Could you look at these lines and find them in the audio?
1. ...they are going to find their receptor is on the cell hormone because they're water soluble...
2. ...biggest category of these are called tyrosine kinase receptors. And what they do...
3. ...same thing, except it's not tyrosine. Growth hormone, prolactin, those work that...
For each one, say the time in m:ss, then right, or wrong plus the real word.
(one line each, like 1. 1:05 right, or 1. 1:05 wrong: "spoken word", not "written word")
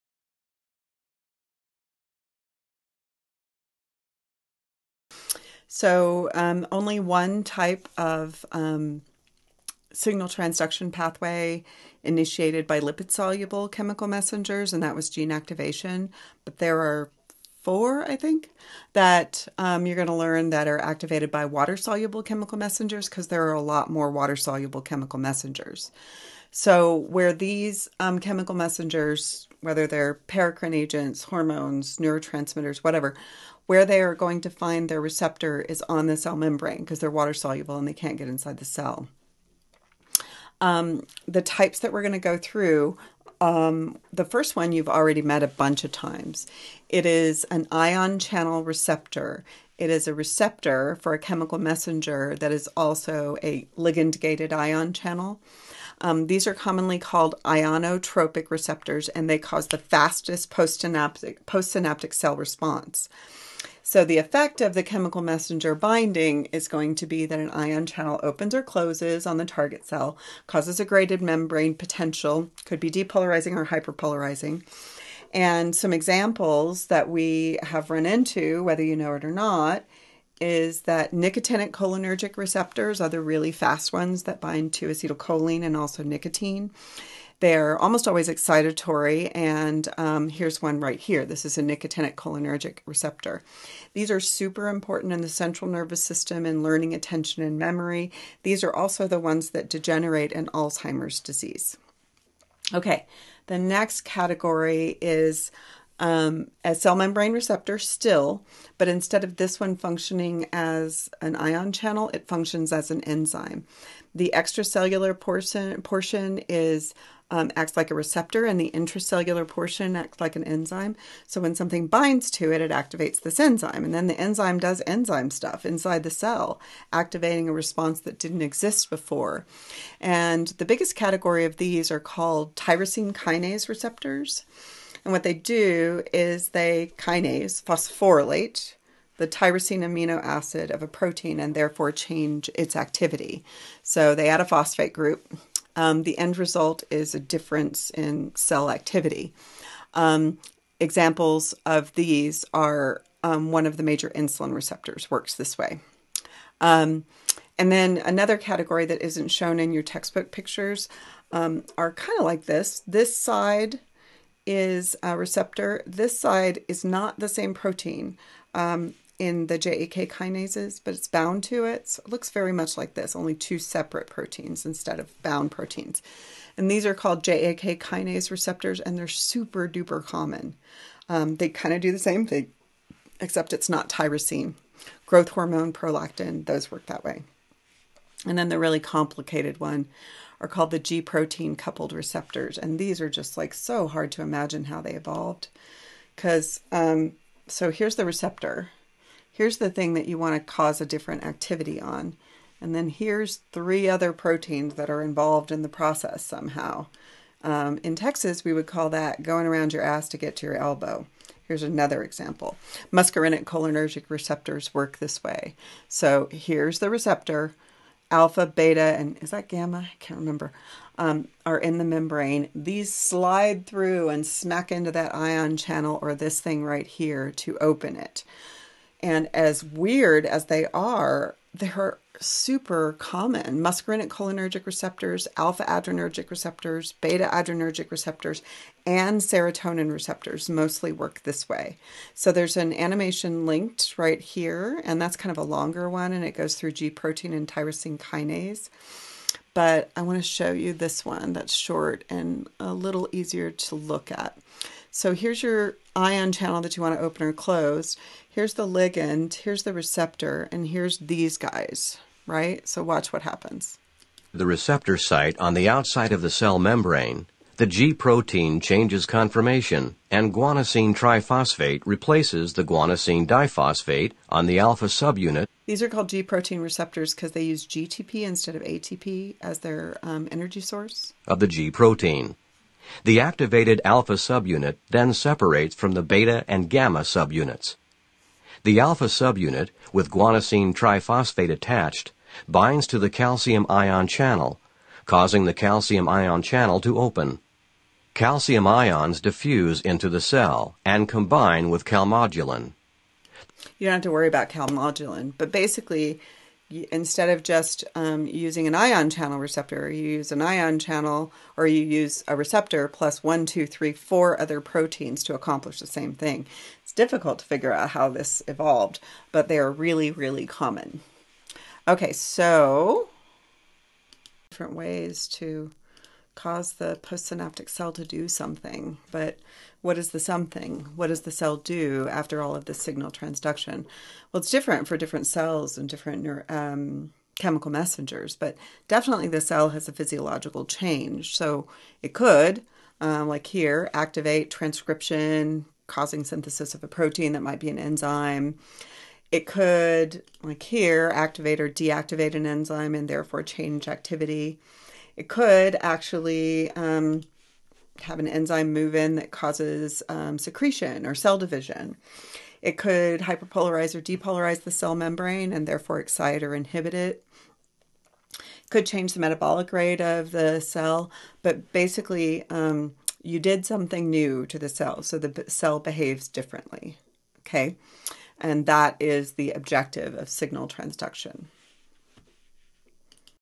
1. 0:33 wrong: "membrane", not "hormone"
2. 2:10 right
3. 3:01 right.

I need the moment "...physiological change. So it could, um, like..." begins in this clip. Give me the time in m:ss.
5:39.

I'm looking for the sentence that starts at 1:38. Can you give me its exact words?
These are also the ones that degenerate in Alzheimer's disease.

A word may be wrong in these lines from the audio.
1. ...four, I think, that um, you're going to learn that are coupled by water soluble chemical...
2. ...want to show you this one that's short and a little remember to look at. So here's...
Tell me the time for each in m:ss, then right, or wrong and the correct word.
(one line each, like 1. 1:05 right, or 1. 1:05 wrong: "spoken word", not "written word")
1. 0:17 wrong: "activated", not "coupled"
2. 4:10 wrong: "easier", not "remember".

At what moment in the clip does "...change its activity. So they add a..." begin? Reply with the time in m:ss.
2:21.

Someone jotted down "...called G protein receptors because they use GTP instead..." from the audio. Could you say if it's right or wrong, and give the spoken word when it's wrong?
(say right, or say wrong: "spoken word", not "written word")
right.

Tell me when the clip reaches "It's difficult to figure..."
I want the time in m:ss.
5:16.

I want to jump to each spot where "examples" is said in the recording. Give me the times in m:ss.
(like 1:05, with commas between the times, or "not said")
1:15, 2:30, 3:32.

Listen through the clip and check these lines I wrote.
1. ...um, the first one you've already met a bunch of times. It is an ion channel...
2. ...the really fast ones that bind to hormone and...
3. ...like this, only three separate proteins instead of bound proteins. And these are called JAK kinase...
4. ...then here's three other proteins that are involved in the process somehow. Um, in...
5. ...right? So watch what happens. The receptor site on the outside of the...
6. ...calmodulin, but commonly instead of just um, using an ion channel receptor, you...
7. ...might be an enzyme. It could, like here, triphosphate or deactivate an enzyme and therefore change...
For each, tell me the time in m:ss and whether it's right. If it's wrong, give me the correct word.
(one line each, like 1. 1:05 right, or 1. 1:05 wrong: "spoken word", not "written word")
1. 0:43 right
2. 1:23 wrong: "acetylcholine", not "hormone"
3. 2:52 wrong: "two", not "three"
4. 3:22 right
5. 4:22 right
6. 5:04 wrong: "basically", not "commonly"
7. 5:47 wrong: "activate", not "triphosphate".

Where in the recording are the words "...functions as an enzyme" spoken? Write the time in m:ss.
1:52.